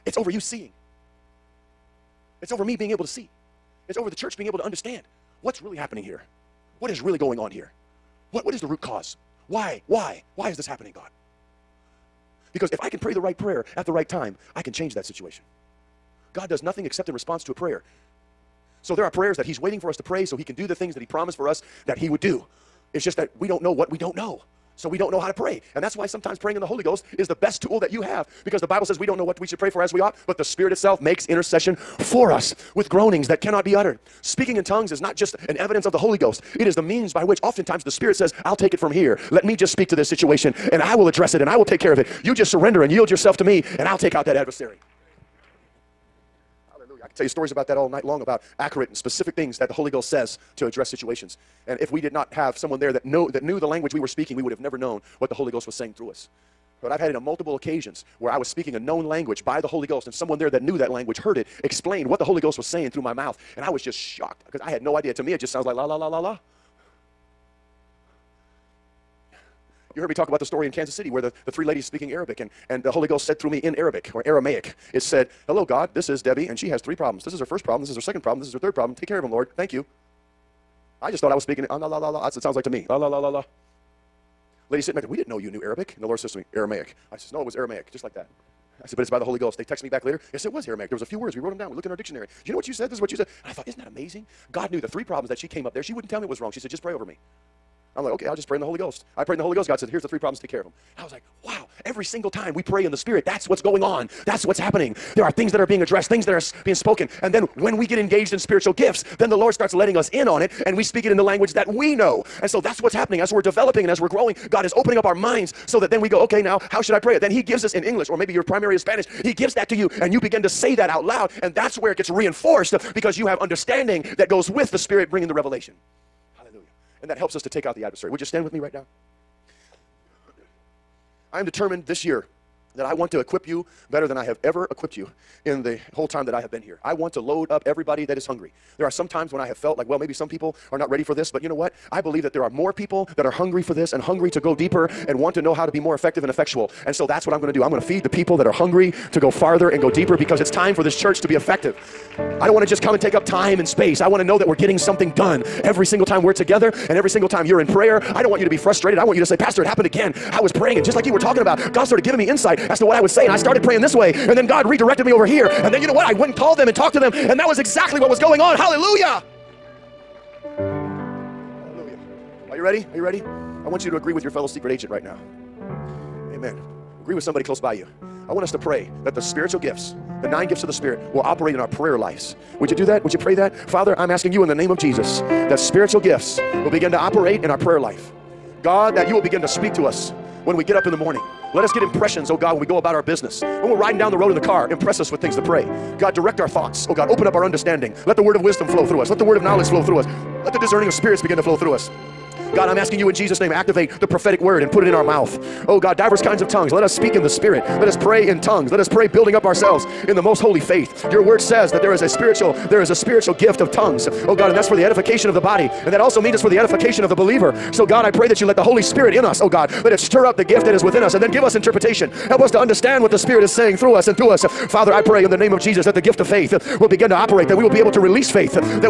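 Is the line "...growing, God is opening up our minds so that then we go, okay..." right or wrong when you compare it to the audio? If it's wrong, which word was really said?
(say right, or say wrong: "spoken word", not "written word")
right.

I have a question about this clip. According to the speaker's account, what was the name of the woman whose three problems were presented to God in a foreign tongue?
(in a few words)
Debbie.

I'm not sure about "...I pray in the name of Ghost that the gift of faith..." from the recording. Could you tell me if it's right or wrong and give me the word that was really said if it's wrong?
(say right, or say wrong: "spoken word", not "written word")
wrong: "Jesus", not "Ghost".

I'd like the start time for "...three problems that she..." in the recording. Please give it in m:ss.
1:34.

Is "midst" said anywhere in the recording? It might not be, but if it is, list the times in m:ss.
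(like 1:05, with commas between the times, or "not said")
not said.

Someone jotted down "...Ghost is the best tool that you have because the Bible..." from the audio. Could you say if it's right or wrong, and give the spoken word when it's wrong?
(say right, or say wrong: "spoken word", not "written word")
right.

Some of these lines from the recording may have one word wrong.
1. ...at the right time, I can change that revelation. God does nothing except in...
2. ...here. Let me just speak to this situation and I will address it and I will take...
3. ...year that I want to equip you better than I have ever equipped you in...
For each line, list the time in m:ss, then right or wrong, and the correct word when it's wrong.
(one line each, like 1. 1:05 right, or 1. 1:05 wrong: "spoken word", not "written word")
1. 0:13 wrong: "situation", not "revelation"
2. 0:38 right
3. 2:12 right.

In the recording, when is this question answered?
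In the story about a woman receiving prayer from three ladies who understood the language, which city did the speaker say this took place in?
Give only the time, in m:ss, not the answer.
1:10.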